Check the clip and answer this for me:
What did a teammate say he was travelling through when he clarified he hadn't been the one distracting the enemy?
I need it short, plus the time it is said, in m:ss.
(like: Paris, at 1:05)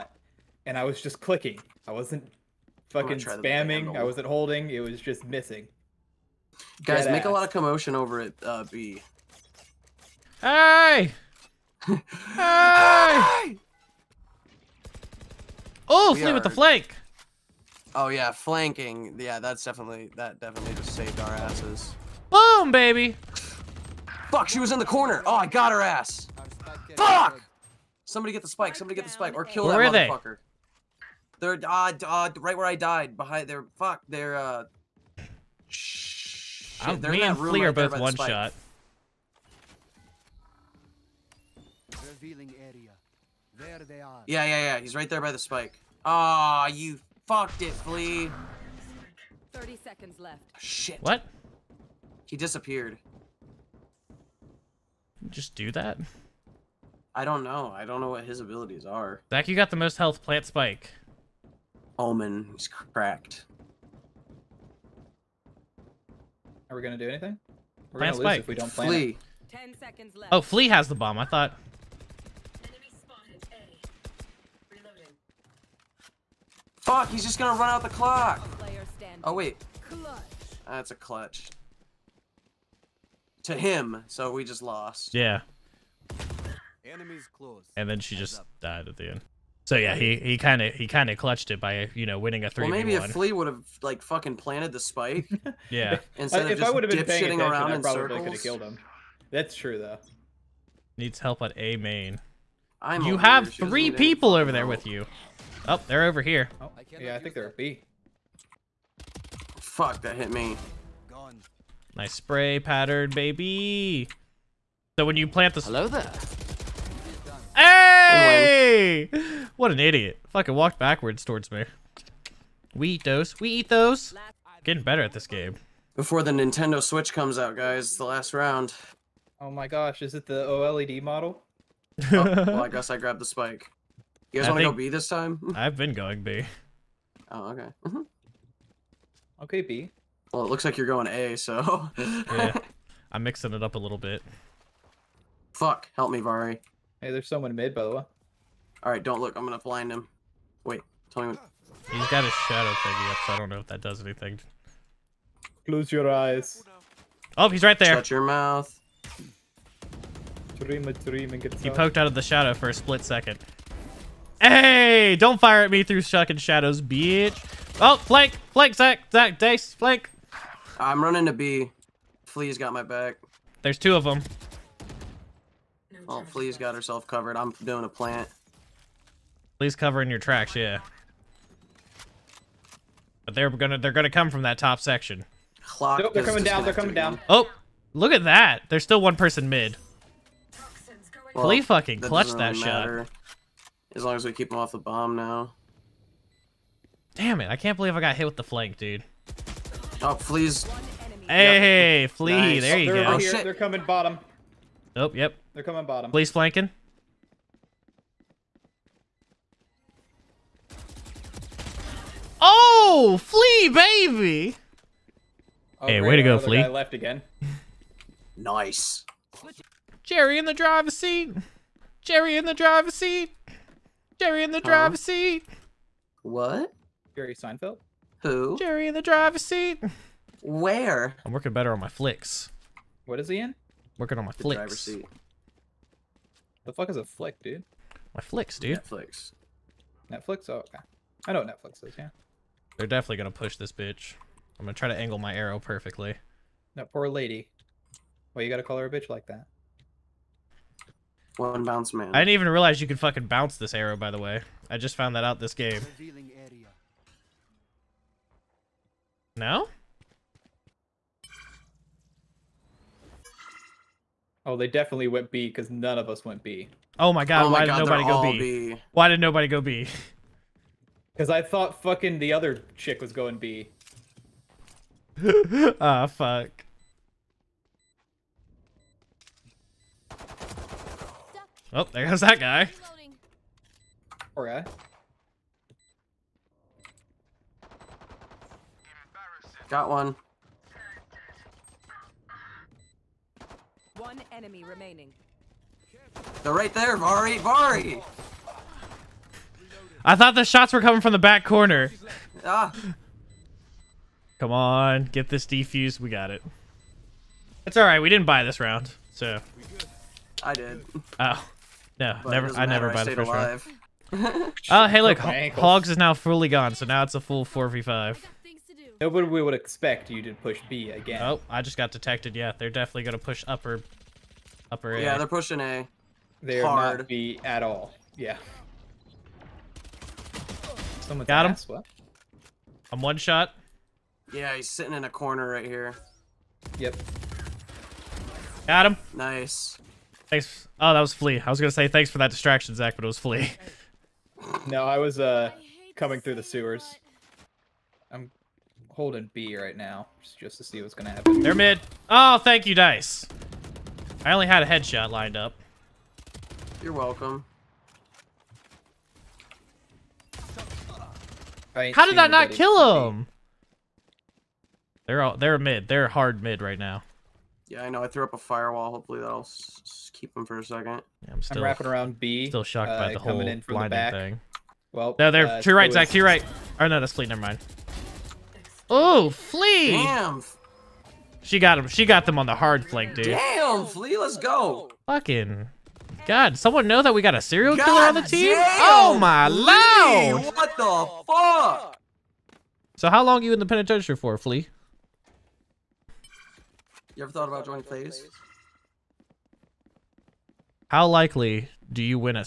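the sewers, at 5:46.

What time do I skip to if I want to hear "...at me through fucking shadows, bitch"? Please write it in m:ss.
2:45.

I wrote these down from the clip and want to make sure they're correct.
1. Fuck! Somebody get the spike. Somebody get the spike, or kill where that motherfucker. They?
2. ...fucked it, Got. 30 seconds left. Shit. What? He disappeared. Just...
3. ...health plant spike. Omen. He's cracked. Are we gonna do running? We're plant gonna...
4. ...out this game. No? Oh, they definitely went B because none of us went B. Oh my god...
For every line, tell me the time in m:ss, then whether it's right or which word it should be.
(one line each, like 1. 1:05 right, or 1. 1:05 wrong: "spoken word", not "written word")
1. 0:26 right
2. 0:47 wrong: "Flea", not "Got"
3. 0:59 wrong: "anything", not "running"
4. 4:15 right.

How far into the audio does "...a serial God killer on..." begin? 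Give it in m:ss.
6:27.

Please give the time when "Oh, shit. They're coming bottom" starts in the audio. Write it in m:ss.
3:23.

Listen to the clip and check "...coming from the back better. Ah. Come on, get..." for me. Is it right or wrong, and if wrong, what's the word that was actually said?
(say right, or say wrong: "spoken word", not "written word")
wrong: "corner", not "better".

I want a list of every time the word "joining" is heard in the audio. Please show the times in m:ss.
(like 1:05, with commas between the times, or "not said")
6:37.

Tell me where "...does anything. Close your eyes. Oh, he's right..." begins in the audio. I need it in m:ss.
2:33.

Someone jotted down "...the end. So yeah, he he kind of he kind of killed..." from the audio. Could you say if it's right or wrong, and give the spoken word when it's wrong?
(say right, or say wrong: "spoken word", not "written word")
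wrong: "clutched", not "killed".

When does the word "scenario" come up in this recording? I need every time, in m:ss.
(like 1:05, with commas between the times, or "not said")
not said.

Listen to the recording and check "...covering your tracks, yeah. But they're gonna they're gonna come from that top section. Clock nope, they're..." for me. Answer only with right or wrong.
right.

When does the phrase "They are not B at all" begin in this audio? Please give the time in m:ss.
5:26.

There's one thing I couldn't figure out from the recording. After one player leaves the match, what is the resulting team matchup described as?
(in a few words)
four v five.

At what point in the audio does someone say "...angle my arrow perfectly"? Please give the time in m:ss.
4:04.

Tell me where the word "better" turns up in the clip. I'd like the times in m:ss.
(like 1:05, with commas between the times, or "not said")
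2:04, 3:51.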